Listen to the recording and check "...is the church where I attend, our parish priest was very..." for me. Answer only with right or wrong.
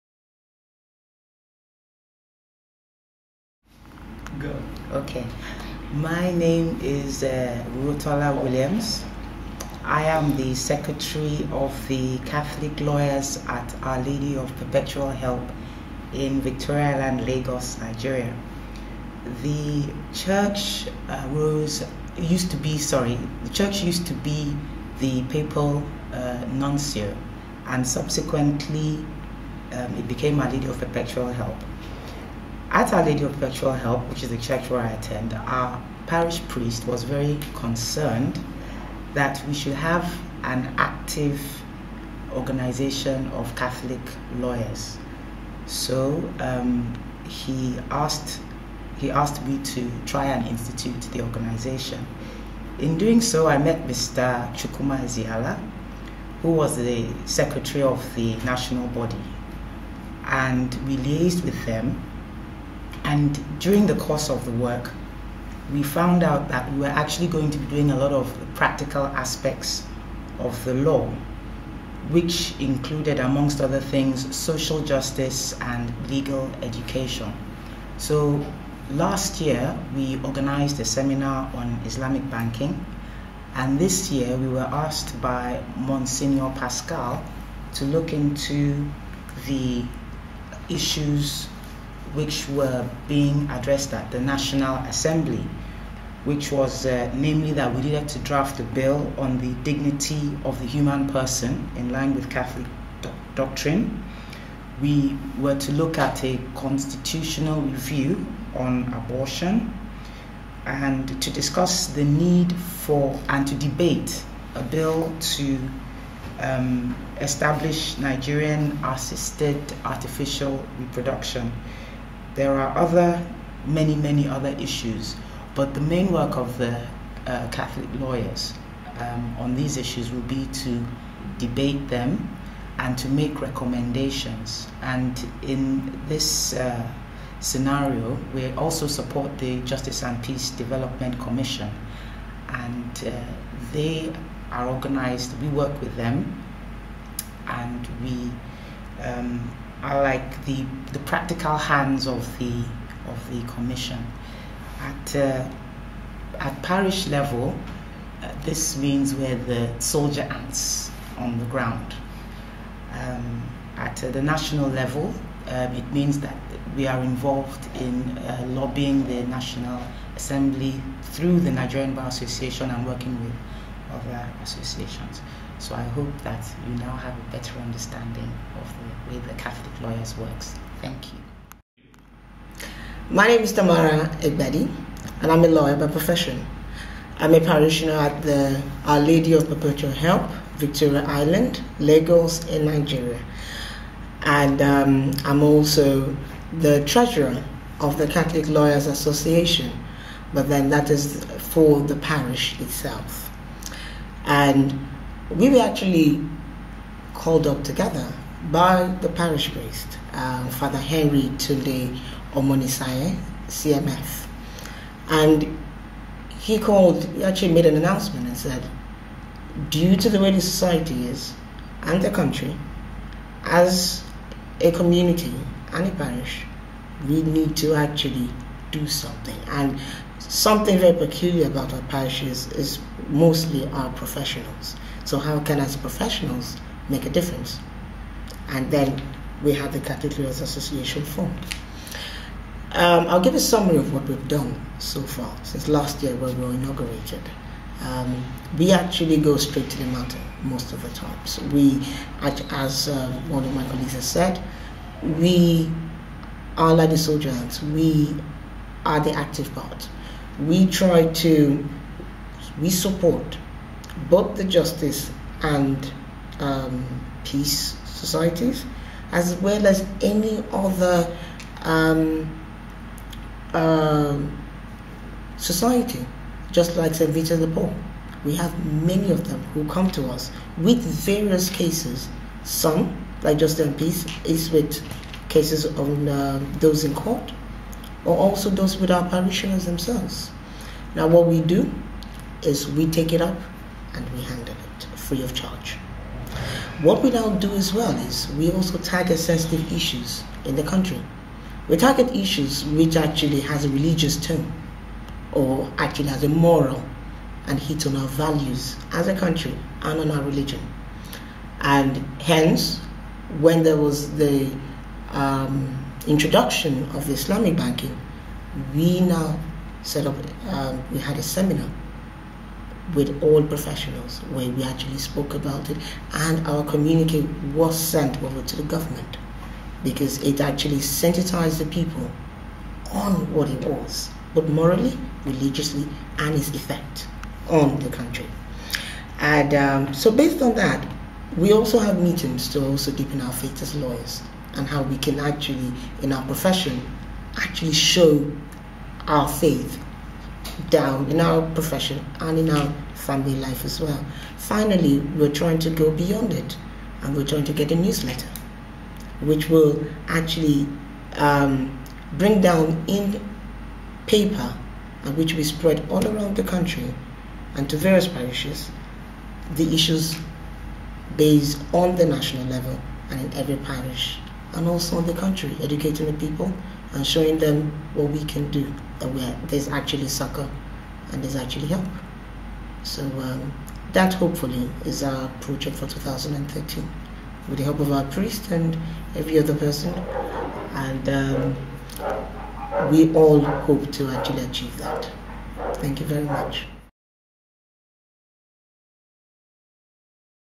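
right.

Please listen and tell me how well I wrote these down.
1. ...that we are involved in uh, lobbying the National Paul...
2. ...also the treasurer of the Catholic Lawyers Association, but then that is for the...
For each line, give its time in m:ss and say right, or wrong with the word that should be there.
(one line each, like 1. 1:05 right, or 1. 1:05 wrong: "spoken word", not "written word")
1. 2:46 wrong: "Assembly", not "Paul"
2. 3:15 right.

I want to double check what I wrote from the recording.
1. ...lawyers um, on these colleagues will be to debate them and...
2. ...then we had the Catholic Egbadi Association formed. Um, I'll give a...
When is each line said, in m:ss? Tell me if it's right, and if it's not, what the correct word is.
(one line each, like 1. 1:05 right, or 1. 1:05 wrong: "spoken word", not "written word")
1. 2:07 wrong: "issues", not "colleagues"
2. 3:58 wrong: "Lawyers", not "Egbadi".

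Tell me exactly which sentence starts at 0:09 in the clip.
I am the secretary of the Catholic Lawyers at Our Lady of Perpetual Help in Victoria Island, Lagos, Nigeria.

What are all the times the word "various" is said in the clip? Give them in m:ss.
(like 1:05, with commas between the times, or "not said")
4:40, 6:07.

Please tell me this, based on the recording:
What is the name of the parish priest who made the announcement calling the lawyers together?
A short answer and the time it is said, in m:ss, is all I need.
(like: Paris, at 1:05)
Father Henry Tunde Omonisaye, at 3:30.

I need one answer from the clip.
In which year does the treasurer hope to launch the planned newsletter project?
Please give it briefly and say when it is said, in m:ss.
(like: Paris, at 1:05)
2013, at 6:25.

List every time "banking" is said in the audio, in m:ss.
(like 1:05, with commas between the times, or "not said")
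1:22, 5:17.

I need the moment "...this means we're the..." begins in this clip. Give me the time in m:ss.
2:38.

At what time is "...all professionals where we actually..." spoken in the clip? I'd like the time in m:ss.
5:23.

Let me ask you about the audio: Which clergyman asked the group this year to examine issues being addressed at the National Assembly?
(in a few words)
Monsignor Pascal.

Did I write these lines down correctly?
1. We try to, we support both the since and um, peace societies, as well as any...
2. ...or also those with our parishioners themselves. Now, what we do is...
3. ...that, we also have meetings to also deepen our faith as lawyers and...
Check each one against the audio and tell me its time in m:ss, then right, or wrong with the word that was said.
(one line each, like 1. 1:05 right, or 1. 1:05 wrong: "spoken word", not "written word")
1. 4:20 wrong: "justice", not "since"
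2. 4:48 right
3. 5:40 right.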